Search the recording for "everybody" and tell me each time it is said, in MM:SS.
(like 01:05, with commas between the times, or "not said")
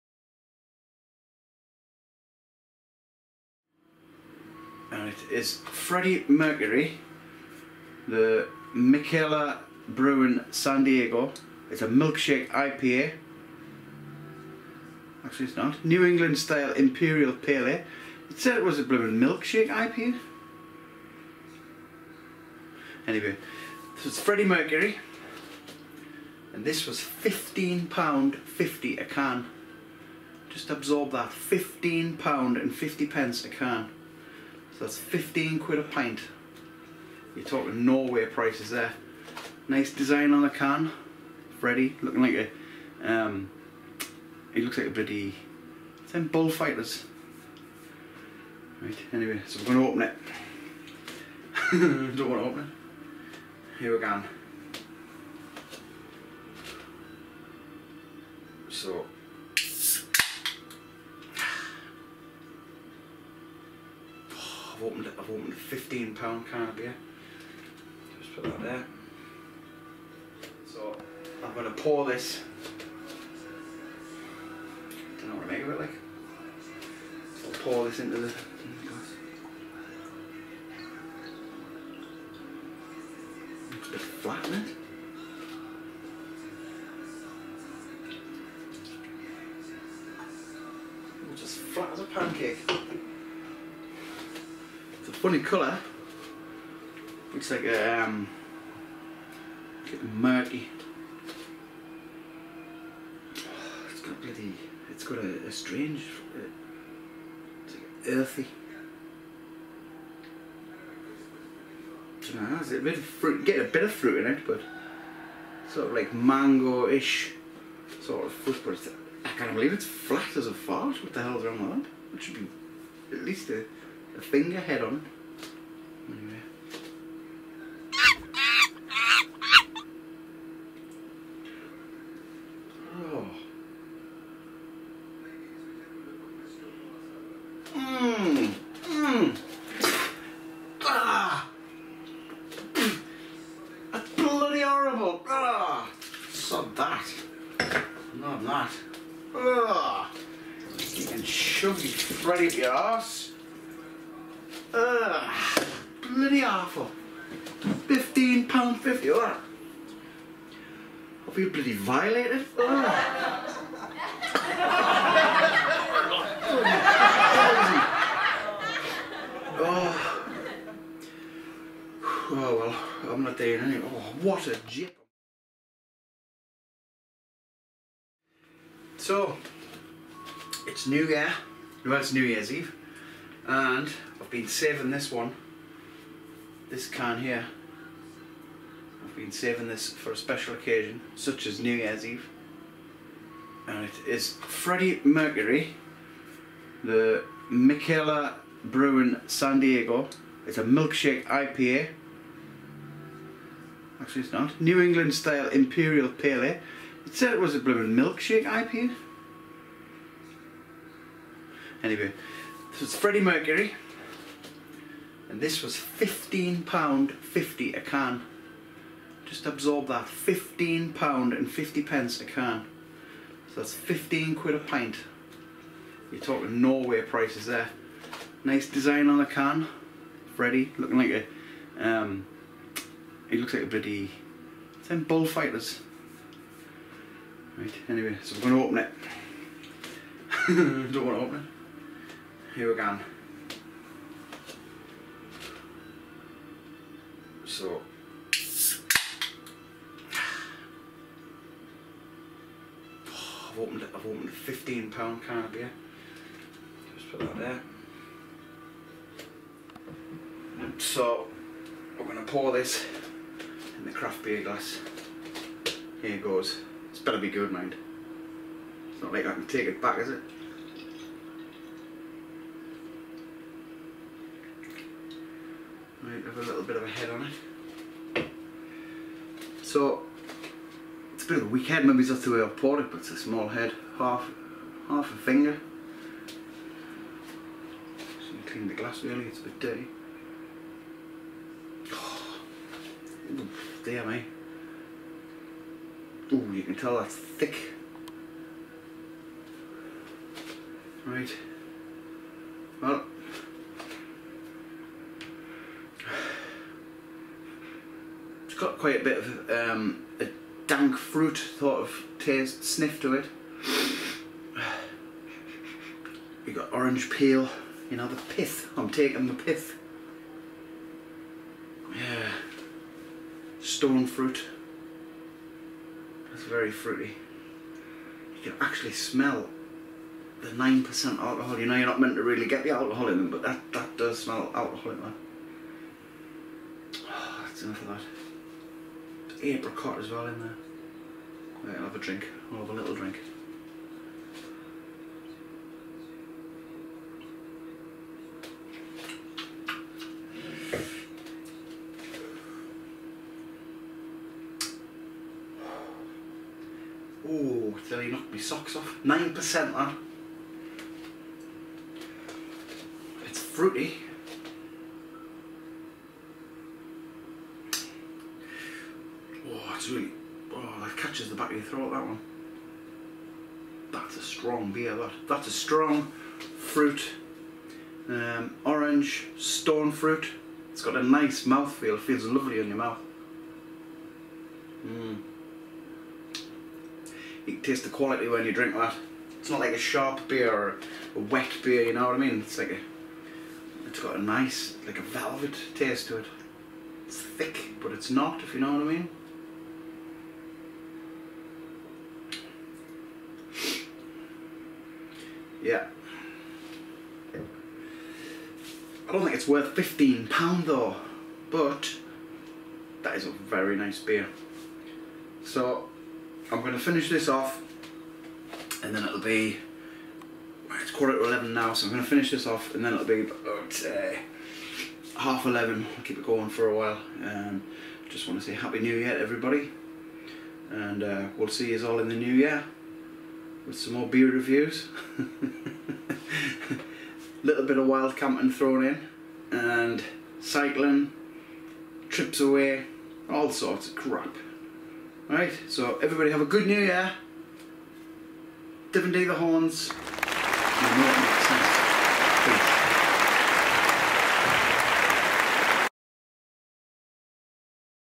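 07:09, 07:26.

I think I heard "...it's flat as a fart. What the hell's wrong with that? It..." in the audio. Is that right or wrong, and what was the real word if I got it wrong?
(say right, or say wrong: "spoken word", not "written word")
right.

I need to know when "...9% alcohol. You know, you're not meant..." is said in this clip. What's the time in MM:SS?
05:30.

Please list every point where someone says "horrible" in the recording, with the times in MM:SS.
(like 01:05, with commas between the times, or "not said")
02:24.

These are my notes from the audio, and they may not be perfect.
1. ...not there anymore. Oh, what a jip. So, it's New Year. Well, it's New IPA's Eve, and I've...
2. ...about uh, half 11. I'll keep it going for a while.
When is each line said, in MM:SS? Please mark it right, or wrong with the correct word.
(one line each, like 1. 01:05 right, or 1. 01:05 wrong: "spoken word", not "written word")
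1. 02:53 wrong: "Year", not "IPA"
2. 07:03 right.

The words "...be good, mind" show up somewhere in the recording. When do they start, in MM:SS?
04:27.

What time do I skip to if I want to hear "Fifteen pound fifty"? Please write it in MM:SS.
02:37.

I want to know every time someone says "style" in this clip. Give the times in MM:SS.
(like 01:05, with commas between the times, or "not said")
00:16, 03:25.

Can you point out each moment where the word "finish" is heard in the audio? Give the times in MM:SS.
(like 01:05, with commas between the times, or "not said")
06:56, 07:02.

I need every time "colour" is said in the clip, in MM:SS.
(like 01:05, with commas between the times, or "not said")
01:35.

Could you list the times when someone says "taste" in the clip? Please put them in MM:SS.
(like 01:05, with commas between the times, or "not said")
05:12, 06:27, 06:35.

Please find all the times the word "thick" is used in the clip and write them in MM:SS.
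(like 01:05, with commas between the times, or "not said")
04:57, 06:37.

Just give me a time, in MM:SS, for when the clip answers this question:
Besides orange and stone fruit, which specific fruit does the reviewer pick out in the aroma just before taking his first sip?
05:39.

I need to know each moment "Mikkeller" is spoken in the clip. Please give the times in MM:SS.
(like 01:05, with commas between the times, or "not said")
00:08, 03:17.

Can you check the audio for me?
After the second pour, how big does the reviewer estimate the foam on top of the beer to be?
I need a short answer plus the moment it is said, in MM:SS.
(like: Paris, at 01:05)
half a finger, at 04:43.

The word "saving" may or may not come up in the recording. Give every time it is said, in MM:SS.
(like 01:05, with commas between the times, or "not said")
03:04, 03:09.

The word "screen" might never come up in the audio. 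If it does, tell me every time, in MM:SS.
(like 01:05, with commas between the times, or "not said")
not said.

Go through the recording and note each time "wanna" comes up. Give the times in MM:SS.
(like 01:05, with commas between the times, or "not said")
00:52, 04:01.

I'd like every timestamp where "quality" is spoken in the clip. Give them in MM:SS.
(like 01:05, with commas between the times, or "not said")
06:27.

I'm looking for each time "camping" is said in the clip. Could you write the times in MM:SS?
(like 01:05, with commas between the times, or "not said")
07:18.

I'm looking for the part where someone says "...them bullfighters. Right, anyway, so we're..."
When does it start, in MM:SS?
00:46.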